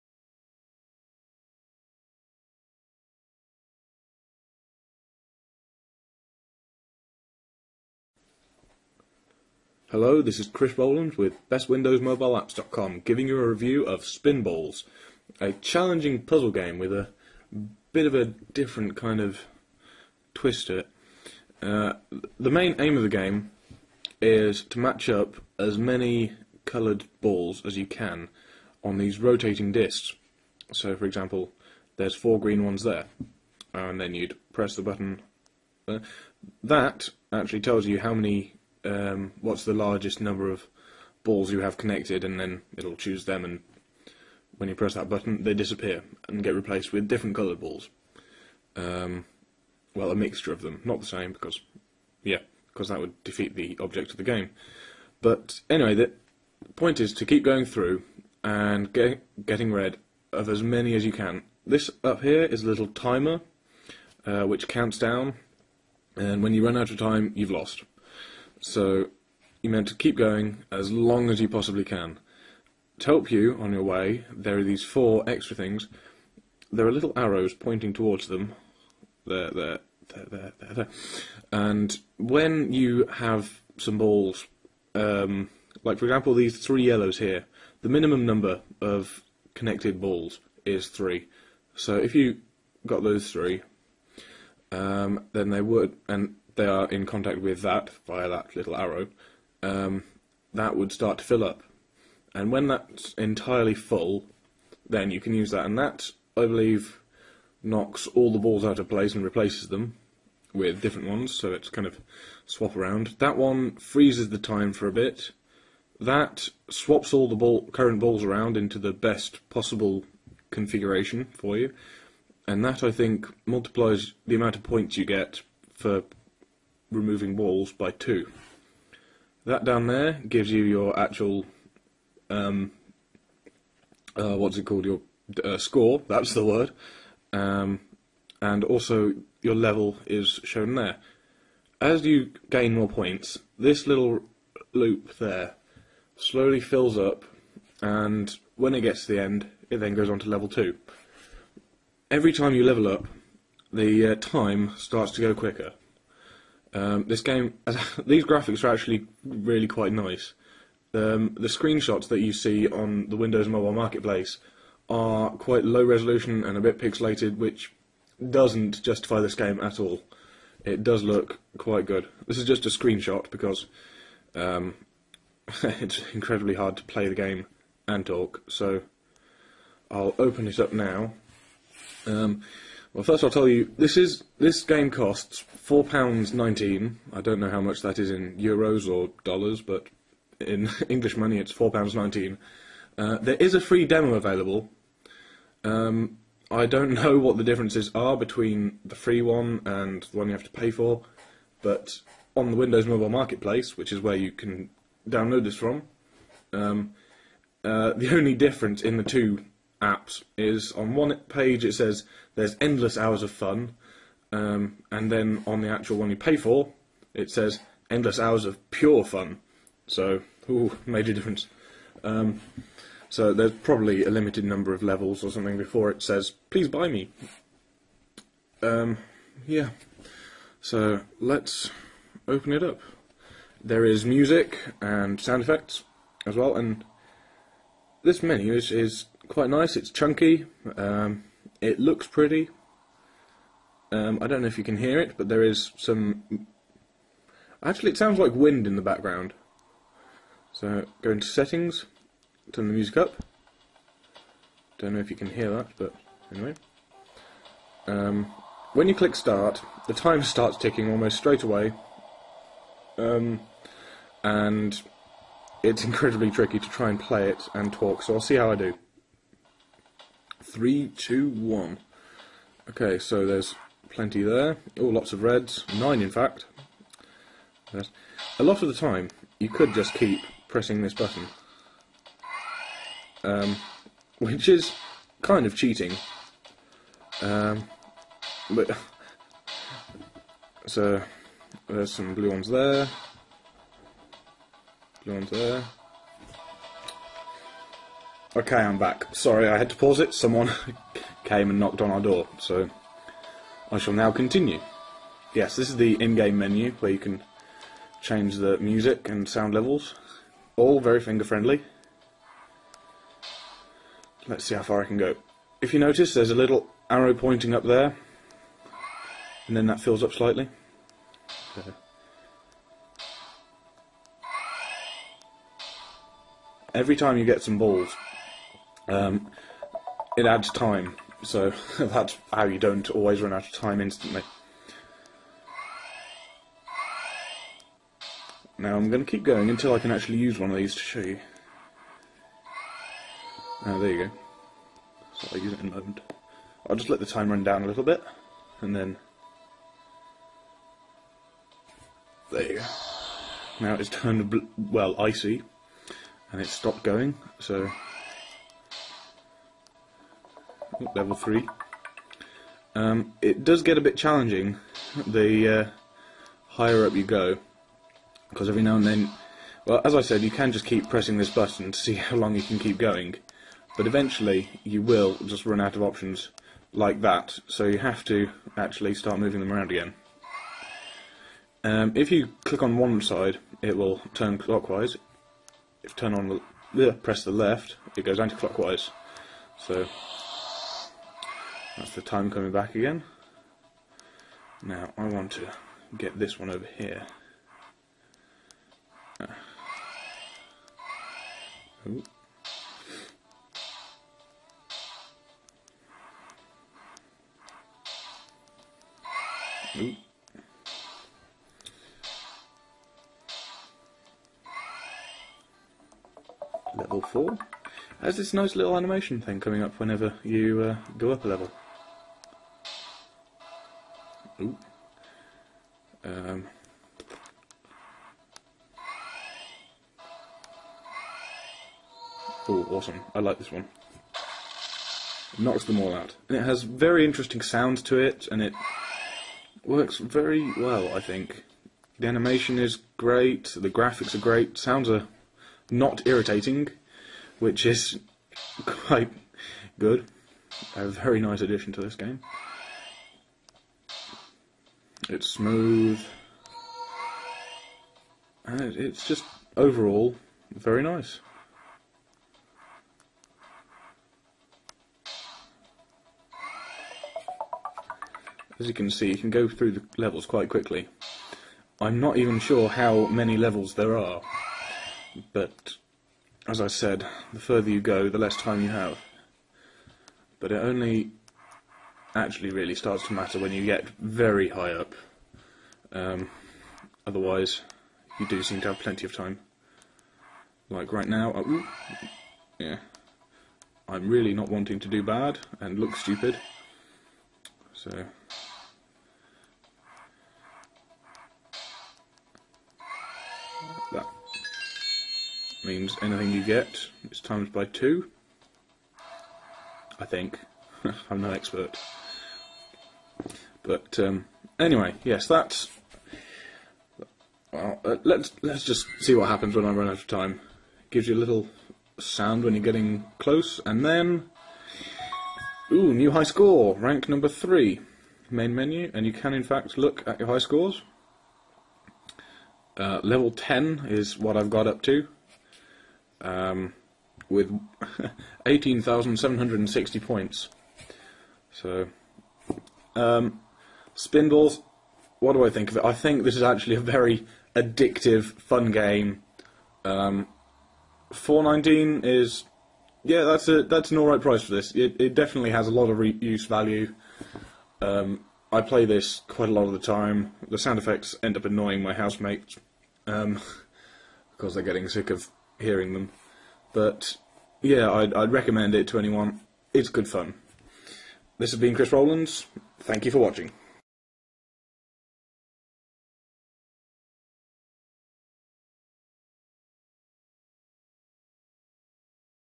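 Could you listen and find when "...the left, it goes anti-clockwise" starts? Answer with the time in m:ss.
6:27.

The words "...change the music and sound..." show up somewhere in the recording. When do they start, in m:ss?
5:08.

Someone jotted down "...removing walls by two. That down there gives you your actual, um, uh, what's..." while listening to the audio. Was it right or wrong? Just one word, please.
right.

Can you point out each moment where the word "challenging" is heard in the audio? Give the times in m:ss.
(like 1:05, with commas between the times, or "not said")
0:15, 6:03.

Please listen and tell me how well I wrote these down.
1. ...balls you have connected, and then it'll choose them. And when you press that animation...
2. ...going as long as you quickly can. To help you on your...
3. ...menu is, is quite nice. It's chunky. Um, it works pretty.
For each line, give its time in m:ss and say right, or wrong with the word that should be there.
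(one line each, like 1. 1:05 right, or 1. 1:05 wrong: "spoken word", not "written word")
1. 0:41 wrong: "button", not "animation"
2. 1:10 wrong: "possibly", not "quickly"
3. 3:58 wrong: "looks", not "works".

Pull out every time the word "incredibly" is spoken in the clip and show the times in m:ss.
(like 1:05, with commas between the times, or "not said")
2:56, 4:25.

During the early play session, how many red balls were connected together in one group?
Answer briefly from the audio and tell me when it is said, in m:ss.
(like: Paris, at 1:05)
9, at 4:35.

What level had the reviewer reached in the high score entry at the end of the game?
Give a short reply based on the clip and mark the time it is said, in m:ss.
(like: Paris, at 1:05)
Level 10, at 8:53.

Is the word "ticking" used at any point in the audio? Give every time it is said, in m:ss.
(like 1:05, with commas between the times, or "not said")
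4:20.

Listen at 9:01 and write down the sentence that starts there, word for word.
So, um, Spinballs, what do I think of it?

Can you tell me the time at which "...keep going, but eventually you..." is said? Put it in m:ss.
6:12.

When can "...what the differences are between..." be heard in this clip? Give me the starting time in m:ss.
3:17.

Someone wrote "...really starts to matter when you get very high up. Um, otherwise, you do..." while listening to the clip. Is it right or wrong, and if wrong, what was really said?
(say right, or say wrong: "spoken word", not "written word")
right.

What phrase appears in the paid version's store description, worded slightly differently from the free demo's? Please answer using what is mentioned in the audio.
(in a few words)
endless hours of pure fun.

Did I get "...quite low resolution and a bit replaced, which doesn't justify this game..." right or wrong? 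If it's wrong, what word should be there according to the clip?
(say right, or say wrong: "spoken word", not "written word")
wrong: "pixelated", not "replaced".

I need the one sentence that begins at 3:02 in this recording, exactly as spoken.
Um, well, first I'll tell you this is this game costs four pounds nineteen.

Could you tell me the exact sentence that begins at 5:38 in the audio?
Now I'm going to keep going until I can actually use one of these to show you.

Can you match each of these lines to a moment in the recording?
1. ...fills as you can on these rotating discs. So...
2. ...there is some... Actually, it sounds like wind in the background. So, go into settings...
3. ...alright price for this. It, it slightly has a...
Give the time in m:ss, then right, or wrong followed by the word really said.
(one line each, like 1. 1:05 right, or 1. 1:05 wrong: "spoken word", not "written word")
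1. 0:27 wrong: "balls", not "fills"
2. 4:05 right
3. 9:13 wrong: "definitely", not "slightly".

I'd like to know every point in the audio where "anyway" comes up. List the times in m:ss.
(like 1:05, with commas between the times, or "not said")
0:55, 4:16, 8:34.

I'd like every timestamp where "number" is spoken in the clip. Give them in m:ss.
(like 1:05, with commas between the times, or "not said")
0:40, 1:28, 3:44, 8:47.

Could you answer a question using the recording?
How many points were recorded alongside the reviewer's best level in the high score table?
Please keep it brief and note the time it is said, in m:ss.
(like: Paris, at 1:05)
18,760, at 8:58.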